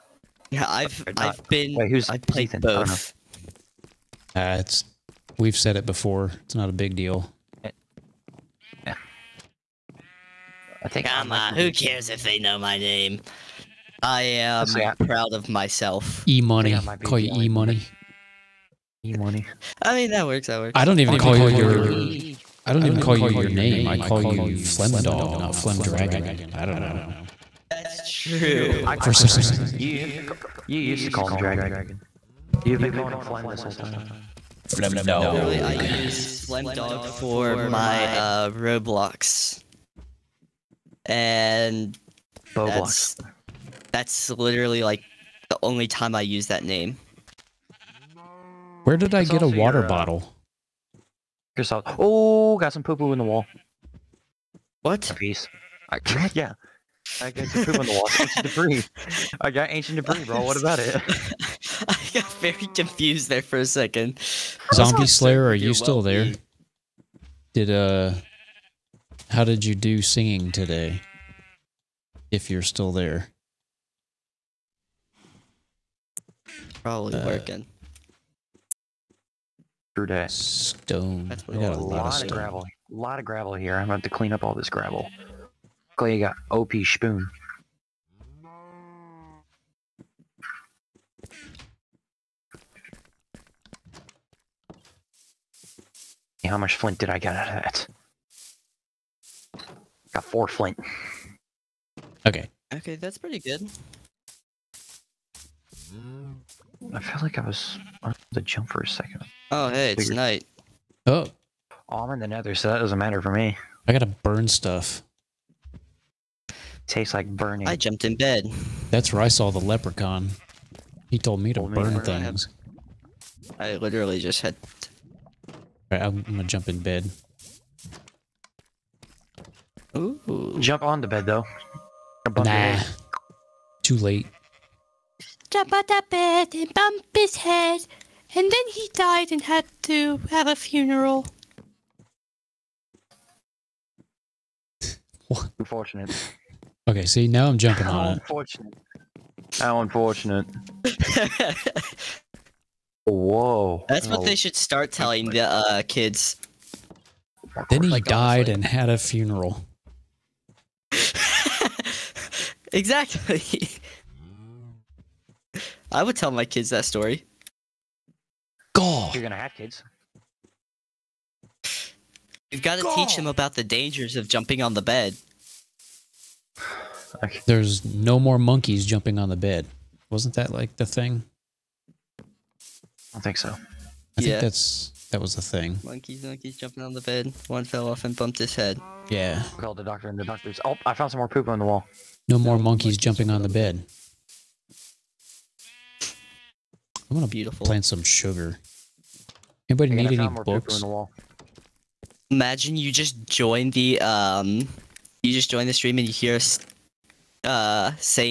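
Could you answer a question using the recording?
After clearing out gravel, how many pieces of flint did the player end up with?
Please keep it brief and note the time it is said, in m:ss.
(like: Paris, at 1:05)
4, at 1:40.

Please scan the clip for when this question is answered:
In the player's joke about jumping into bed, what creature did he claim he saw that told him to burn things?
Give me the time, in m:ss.
1:59.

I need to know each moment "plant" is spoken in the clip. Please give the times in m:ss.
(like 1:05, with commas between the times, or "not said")
3:17.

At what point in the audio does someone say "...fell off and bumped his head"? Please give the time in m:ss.
3:07.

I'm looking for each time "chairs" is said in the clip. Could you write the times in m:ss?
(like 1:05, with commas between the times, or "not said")
not said.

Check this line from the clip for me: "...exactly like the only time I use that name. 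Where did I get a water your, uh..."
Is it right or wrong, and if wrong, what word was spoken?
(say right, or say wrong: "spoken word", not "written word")
wrong: "literally", not "exactly".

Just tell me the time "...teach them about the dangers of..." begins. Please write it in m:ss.
2:52.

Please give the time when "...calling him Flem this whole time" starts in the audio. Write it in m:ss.
0:32.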